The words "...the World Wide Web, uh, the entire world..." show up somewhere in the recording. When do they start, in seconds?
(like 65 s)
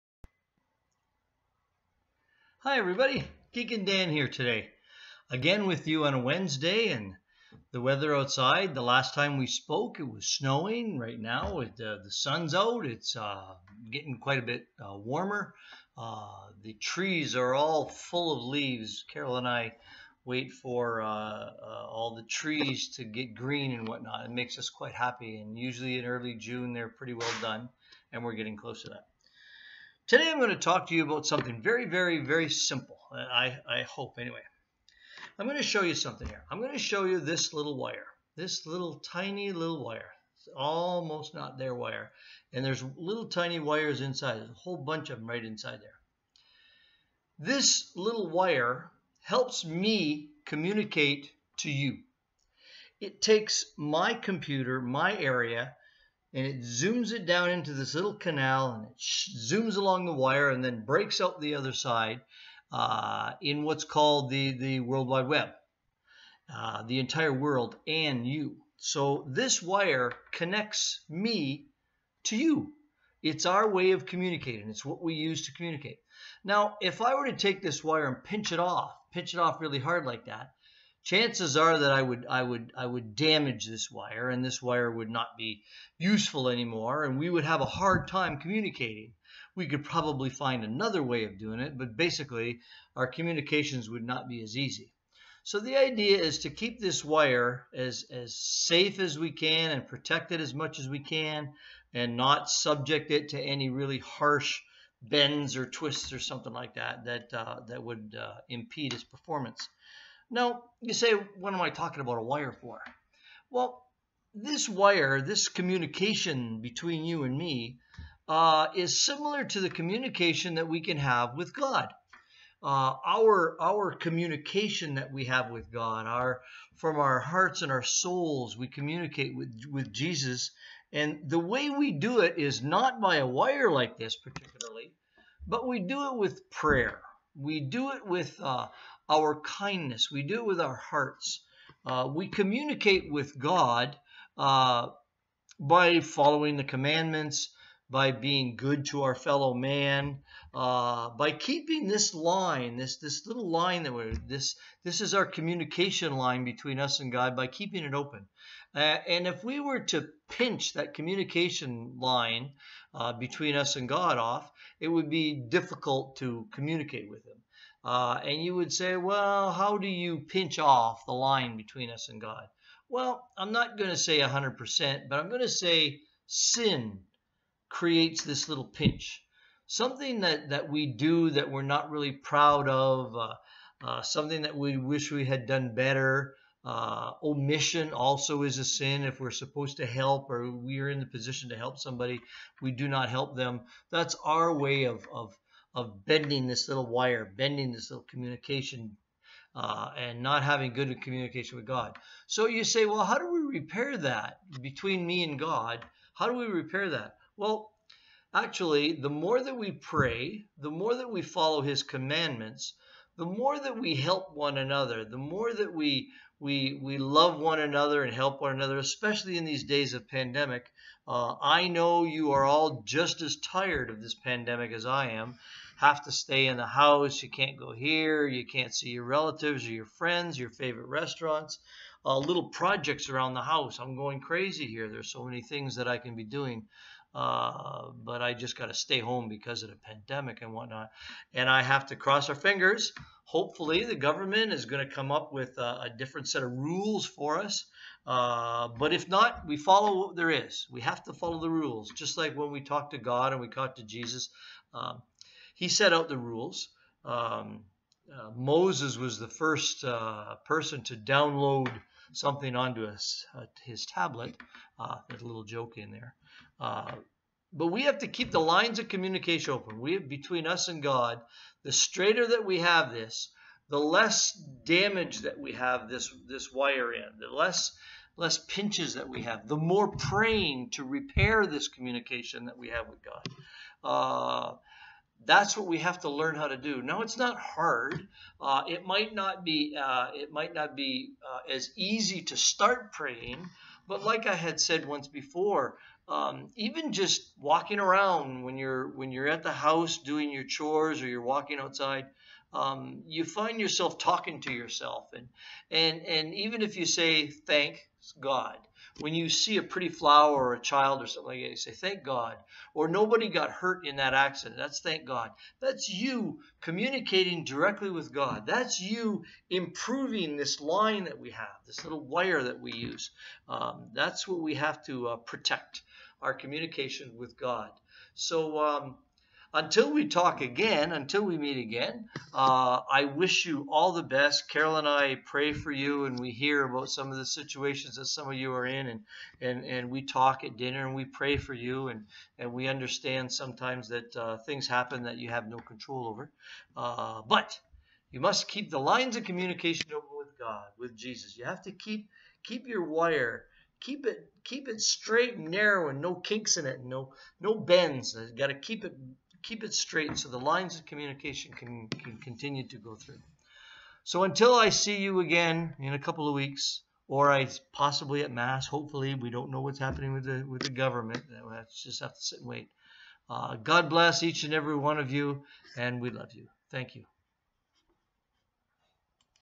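64 s.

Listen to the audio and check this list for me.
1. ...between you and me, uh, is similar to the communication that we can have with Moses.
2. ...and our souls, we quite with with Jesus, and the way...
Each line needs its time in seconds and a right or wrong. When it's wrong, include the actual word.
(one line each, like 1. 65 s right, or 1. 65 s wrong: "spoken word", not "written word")
1. 116 s wrong: "God", not "Moses"
2. 127 s wrong: "communicate", not "quite".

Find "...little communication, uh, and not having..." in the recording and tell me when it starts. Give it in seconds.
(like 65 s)
197 s.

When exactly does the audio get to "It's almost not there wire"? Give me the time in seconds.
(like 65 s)
40 s.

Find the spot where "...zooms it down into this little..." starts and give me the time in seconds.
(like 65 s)
56 s.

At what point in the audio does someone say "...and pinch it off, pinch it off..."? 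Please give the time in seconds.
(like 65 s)
78 s.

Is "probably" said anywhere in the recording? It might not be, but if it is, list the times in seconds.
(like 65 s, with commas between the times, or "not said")
89 s.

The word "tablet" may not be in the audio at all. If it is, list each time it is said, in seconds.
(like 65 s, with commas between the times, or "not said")
263 s.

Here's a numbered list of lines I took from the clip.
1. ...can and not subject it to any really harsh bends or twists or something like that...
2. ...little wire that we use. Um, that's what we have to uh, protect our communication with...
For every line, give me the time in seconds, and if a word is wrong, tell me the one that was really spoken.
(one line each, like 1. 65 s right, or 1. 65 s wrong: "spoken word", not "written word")
1. 100 s right
2. 321 s right.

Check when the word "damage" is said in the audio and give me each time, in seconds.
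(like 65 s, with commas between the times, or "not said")
83 s, 274 s.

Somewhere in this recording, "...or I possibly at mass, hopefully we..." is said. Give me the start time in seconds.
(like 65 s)
367 s.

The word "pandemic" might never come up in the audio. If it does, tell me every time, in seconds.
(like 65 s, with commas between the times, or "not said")
220 s, 224 s, 239 s.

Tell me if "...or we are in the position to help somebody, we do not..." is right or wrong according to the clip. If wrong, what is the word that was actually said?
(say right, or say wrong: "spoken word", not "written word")
right.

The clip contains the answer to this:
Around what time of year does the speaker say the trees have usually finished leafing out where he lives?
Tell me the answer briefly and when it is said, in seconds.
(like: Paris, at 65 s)
Early June, at 26 s.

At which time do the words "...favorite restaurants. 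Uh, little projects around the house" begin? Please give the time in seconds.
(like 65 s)
230 s.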